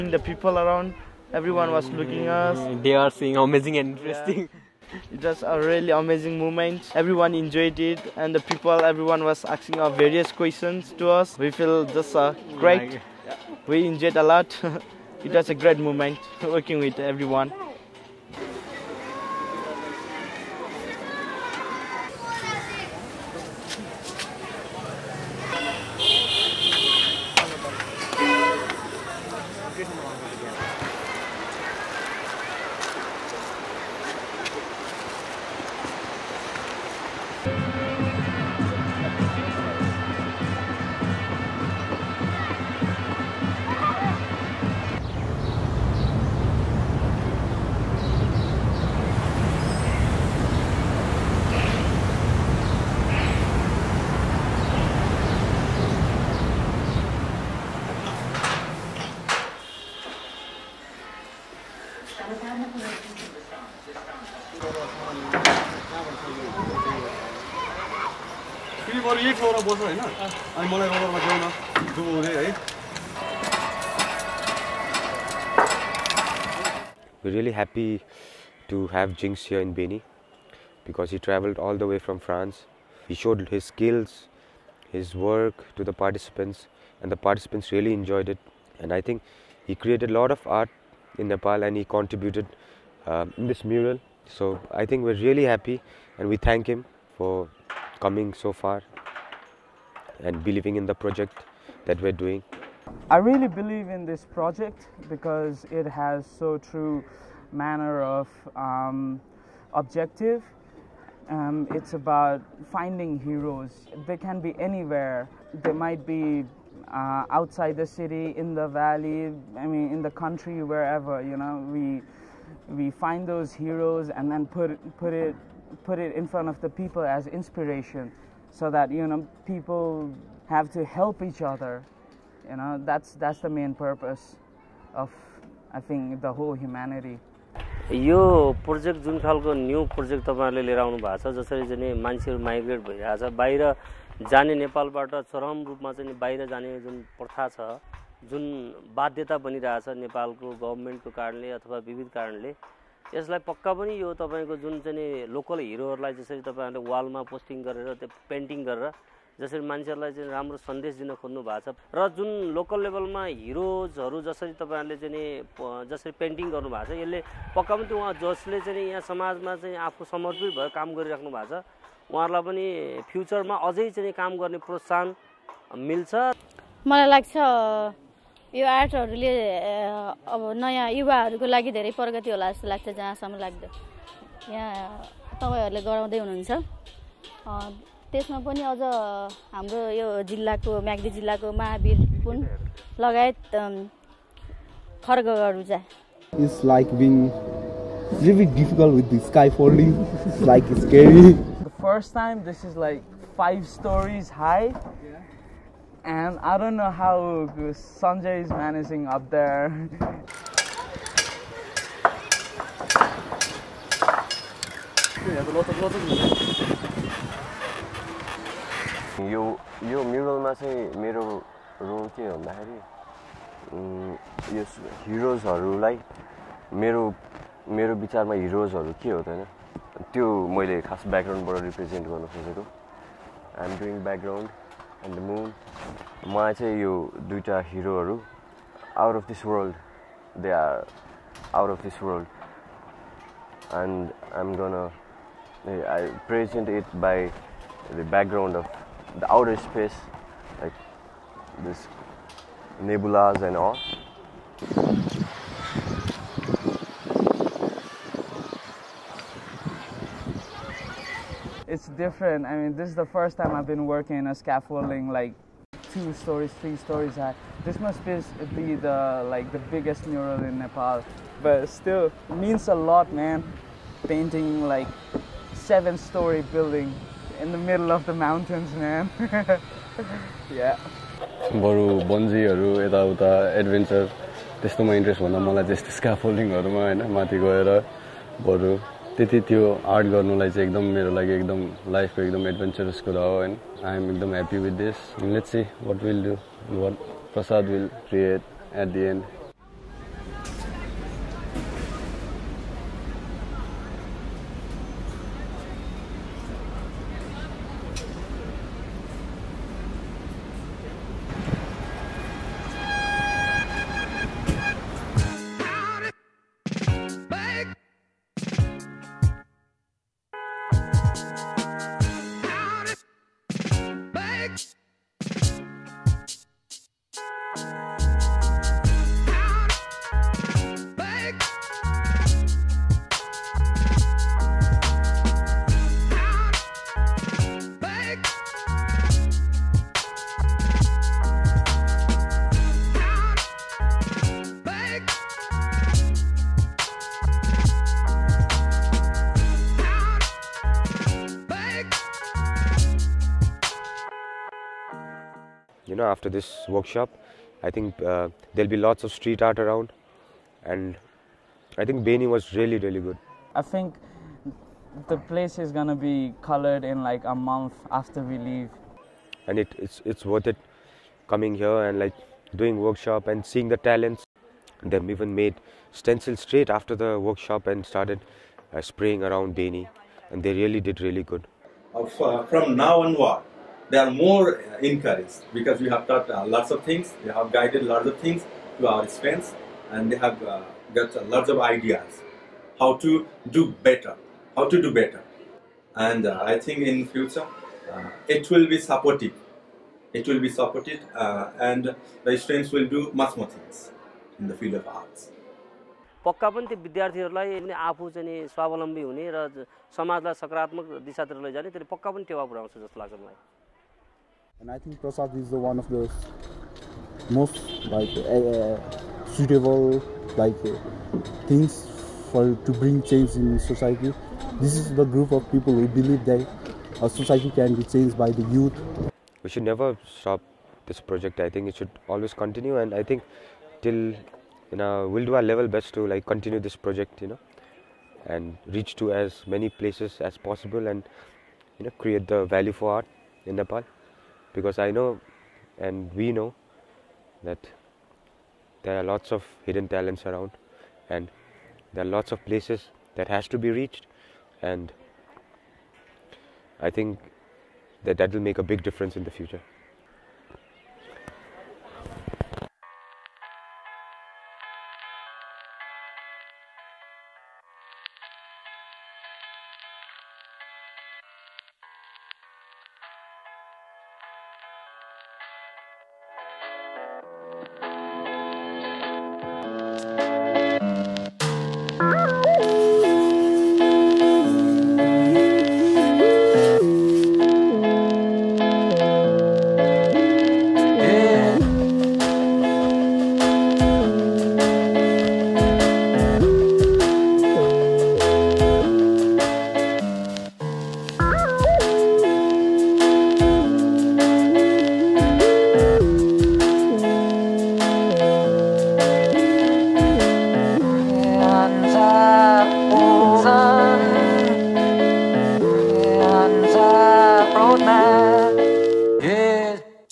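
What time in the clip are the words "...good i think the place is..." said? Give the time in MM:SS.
06:03.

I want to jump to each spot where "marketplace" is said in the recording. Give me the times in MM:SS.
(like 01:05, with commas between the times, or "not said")
not said.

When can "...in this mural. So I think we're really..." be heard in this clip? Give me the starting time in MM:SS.
01:33.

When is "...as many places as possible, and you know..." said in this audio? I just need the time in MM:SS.
07:19.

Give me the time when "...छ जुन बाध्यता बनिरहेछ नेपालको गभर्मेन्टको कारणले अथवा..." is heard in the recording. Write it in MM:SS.
02:27.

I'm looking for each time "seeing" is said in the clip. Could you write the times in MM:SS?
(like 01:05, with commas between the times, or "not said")
00:03, 06:13.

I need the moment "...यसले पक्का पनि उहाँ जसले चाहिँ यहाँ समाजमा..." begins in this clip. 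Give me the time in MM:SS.
02:47.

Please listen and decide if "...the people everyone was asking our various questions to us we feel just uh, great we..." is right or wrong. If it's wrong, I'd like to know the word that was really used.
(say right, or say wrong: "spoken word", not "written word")
right.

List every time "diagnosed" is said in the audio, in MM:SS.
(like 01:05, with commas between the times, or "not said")
not said.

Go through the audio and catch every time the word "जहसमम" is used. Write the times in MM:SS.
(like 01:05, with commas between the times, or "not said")
03:02.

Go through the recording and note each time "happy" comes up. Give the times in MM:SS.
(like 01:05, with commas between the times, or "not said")
01:17, 01:35.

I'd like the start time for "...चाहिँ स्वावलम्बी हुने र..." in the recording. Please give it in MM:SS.
06:48.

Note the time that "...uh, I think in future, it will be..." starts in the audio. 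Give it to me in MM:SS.
06:36.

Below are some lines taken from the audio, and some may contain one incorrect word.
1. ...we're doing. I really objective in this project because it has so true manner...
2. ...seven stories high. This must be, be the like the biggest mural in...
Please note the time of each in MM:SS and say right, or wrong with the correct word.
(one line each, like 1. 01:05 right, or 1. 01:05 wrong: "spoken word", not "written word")
1. 01:42 wrong: "believe", not "objective"
2. 04:26 wrong: "three", not "seven".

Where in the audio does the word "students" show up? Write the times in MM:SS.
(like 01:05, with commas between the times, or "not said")
06:29, 06:42.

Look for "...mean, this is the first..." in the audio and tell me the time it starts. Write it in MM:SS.
04:22.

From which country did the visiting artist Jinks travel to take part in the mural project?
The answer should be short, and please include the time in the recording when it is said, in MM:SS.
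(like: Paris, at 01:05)
France, at 01:22.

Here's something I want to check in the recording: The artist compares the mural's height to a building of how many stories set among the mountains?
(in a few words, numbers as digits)
7.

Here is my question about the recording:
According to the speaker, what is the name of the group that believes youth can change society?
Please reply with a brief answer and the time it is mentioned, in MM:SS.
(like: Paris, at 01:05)
Prasad, at 06:55.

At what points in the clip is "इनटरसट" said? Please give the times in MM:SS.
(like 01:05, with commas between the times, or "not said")
04:44.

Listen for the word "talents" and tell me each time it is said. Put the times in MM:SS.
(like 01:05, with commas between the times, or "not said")
06:13, 07:29.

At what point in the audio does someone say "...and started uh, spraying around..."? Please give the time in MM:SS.
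06:17.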